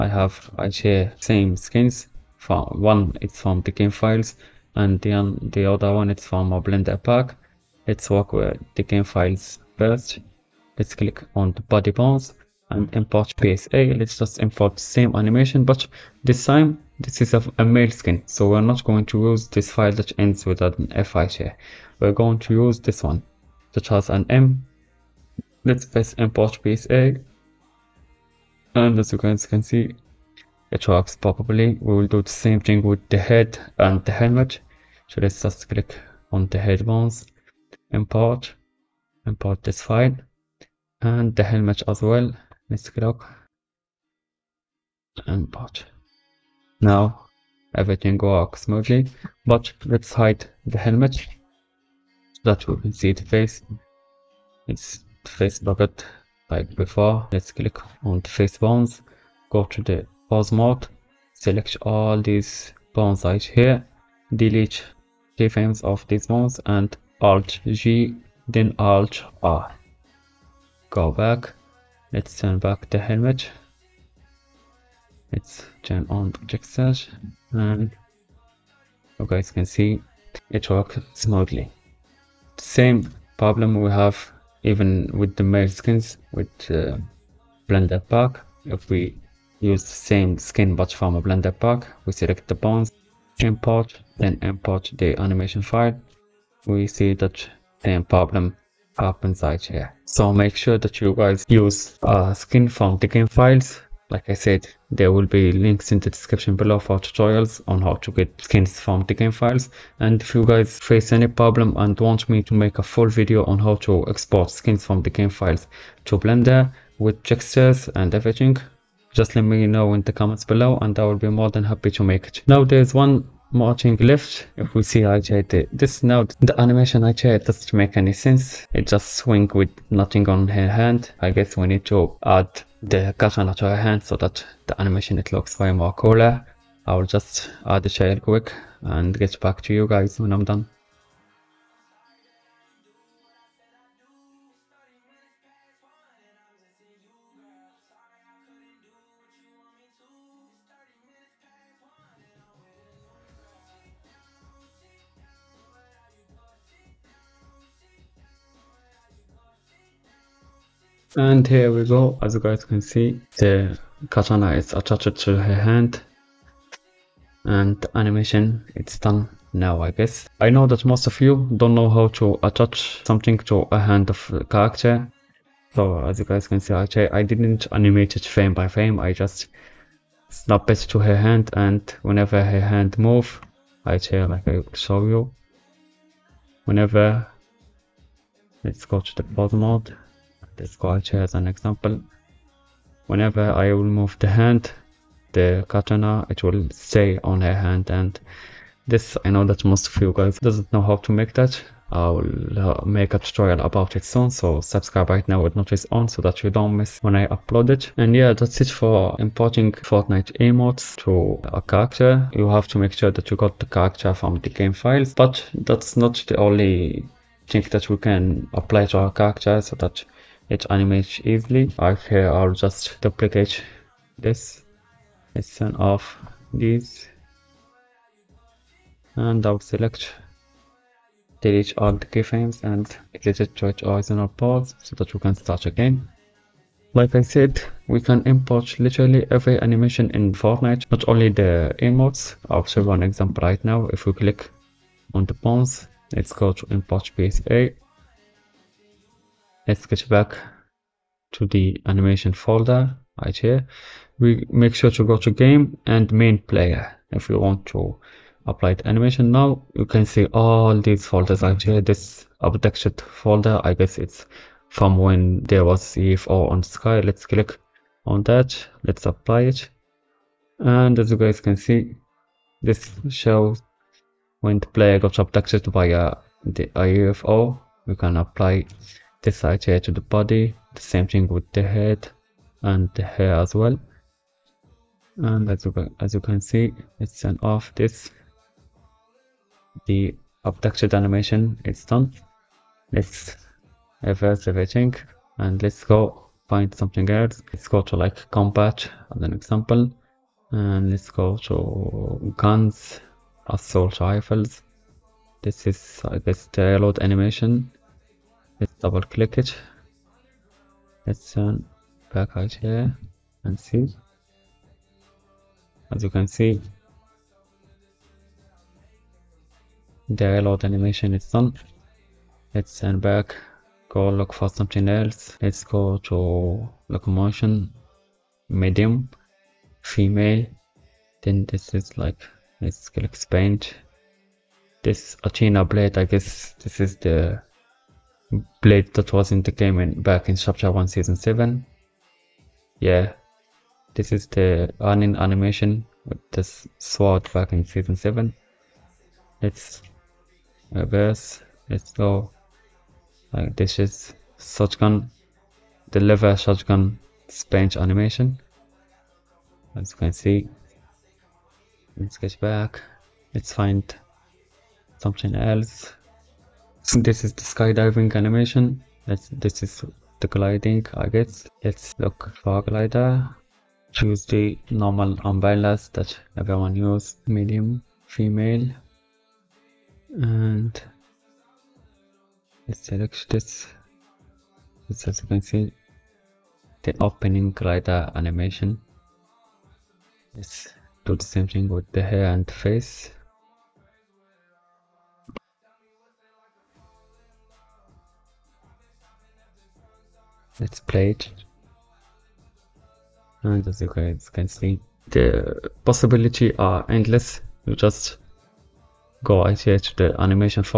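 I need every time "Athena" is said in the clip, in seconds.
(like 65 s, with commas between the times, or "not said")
335 s.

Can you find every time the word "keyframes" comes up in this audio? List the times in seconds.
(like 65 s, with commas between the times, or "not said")
65 s, 232 s.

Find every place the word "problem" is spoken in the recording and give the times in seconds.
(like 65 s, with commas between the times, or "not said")
83 s, 98 s, 111 s.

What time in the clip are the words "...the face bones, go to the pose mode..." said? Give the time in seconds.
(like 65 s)
58 s.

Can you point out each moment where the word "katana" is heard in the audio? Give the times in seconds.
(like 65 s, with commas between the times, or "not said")
133 s, 164 s, 195 s.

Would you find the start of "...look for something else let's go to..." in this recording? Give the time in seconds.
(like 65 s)
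324 s.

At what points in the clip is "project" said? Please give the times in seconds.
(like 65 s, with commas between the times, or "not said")
76 s.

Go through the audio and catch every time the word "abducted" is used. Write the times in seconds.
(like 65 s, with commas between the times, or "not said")
262 s, 275 s, 290 s.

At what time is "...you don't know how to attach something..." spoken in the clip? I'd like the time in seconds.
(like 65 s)
171 s.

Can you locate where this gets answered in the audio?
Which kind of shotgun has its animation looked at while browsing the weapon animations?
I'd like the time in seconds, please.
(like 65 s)
355 s.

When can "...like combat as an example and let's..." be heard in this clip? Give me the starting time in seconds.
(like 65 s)
297 s.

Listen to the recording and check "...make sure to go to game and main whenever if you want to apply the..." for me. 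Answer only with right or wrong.
wrong.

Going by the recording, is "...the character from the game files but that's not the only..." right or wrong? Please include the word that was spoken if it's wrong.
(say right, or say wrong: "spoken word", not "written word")
right.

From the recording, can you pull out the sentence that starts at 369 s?
That's, this is the gliding, I guess.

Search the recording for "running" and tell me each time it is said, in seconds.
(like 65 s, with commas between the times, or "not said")
344 s.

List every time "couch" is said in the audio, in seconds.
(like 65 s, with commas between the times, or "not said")
not said.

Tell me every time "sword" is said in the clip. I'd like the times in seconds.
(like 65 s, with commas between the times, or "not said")
346 s.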